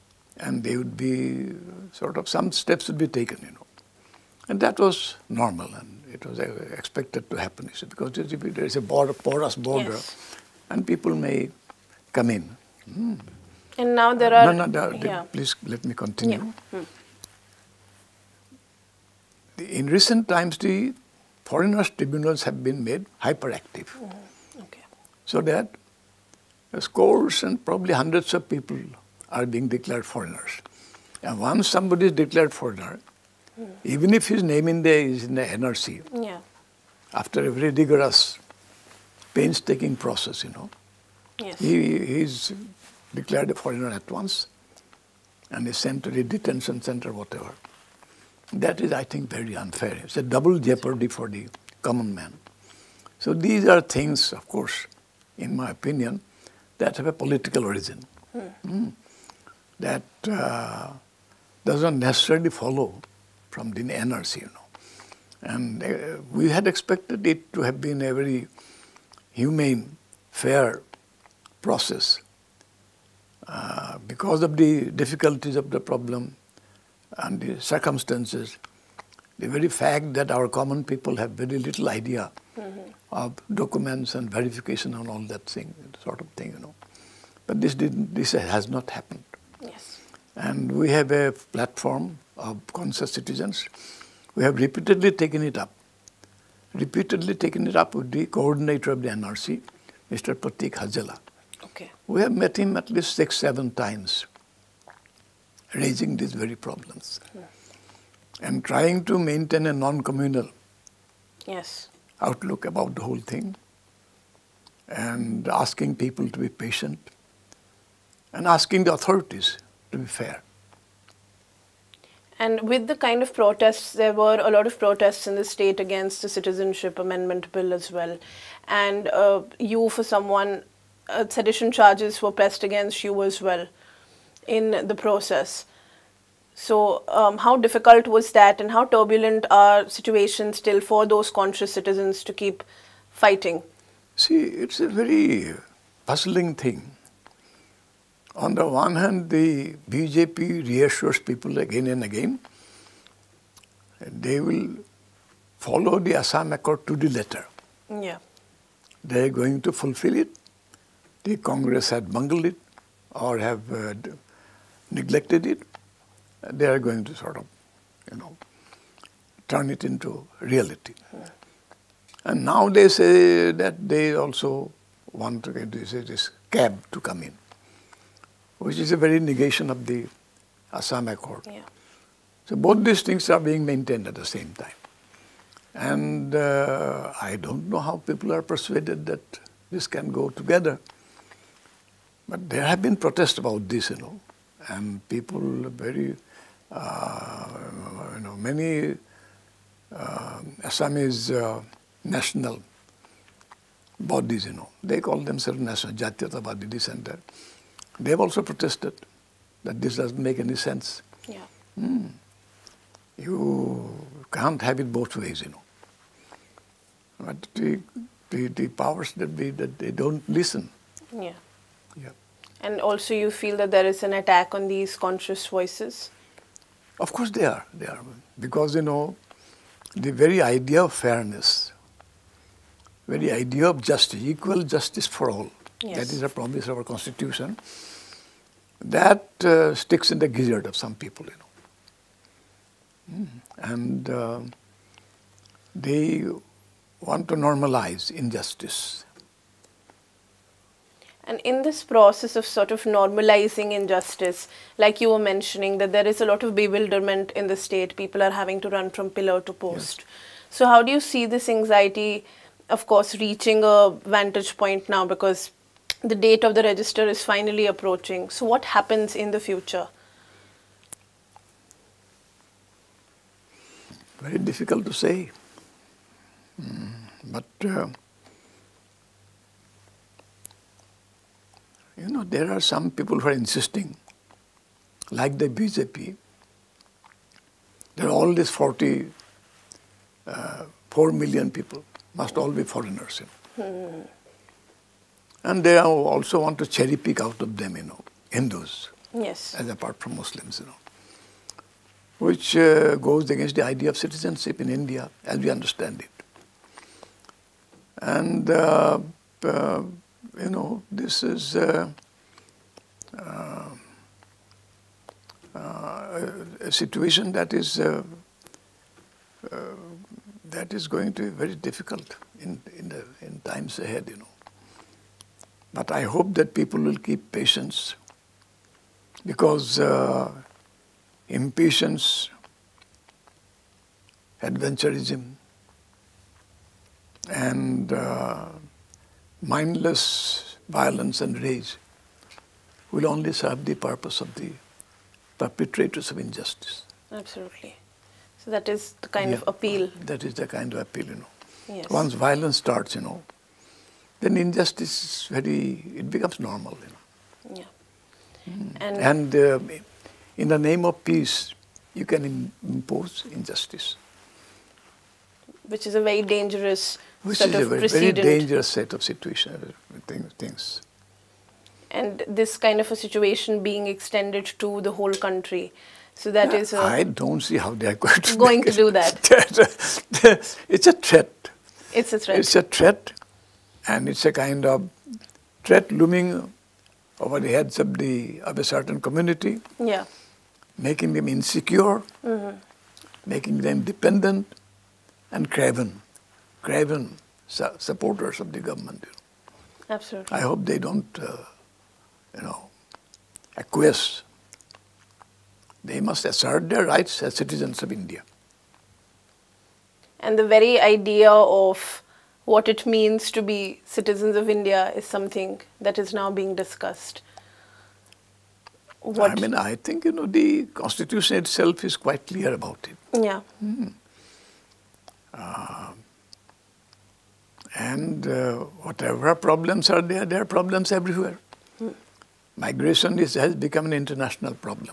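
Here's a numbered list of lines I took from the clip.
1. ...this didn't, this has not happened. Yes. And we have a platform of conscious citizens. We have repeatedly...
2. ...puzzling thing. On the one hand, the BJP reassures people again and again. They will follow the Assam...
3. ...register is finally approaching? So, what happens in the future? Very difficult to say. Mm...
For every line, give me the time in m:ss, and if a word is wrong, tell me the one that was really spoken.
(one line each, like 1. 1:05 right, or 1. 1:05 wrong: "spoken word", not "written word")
1. 1:27 right
2. 2:26 right
3. 4:26 right.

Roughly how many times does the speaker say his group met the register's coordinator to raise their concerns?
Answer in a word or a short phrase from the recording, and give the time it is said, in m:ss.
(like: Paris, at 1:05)
6 or 7 times, at 1:43.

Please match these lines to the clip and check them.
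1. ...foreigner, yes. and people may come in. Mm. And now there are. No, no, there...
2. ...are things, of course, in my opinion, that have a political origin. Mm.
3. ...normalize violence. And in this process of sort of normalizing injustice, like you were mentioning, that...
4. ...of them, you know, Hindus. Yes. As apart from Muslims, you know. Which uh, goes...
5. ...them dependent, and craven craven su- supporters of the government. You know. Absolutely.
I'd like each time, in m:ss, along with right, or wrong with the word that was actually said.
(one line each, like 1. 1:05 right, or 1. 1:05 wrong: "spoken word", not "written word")
1. 0:09 wrong: "border", not "foreigner"
2. 0:53 right
3. 4:07 wrong: "injustice", not "violence"
4. 4:57 right
5. 6:33 right.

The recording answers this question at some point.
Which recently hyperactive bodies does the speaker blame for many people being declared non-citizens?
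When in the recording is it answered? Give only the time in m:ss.
0:21.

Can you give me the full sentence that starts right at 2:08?
And uh, you, for someone, uh, sedition charges were pressed against you as well in the process.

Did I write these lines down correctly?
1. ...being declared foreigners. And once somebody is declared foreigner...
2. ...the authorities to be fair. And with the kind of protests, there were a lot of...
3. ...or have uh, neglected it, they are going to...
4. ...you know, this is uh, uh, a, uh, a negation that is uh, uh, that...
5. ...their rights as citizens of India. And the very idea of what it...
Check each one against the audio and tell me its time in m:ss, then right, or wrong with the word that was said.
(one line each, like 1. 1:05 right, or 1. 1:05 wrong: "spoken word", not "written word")
1. 0:29 right
2. 1:58 right
3. 2:43 right
4. 5:10 wrong: "situation", not "negation"
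5. 6:46 right.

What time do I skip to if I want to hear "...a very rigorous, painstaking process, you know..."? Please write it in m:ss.
0:37.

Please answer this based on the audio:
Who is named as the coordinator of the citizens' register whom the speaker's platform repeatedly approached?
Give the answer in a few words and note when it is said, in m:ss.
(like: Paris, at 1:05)
Pratik Hajela, at 1:40.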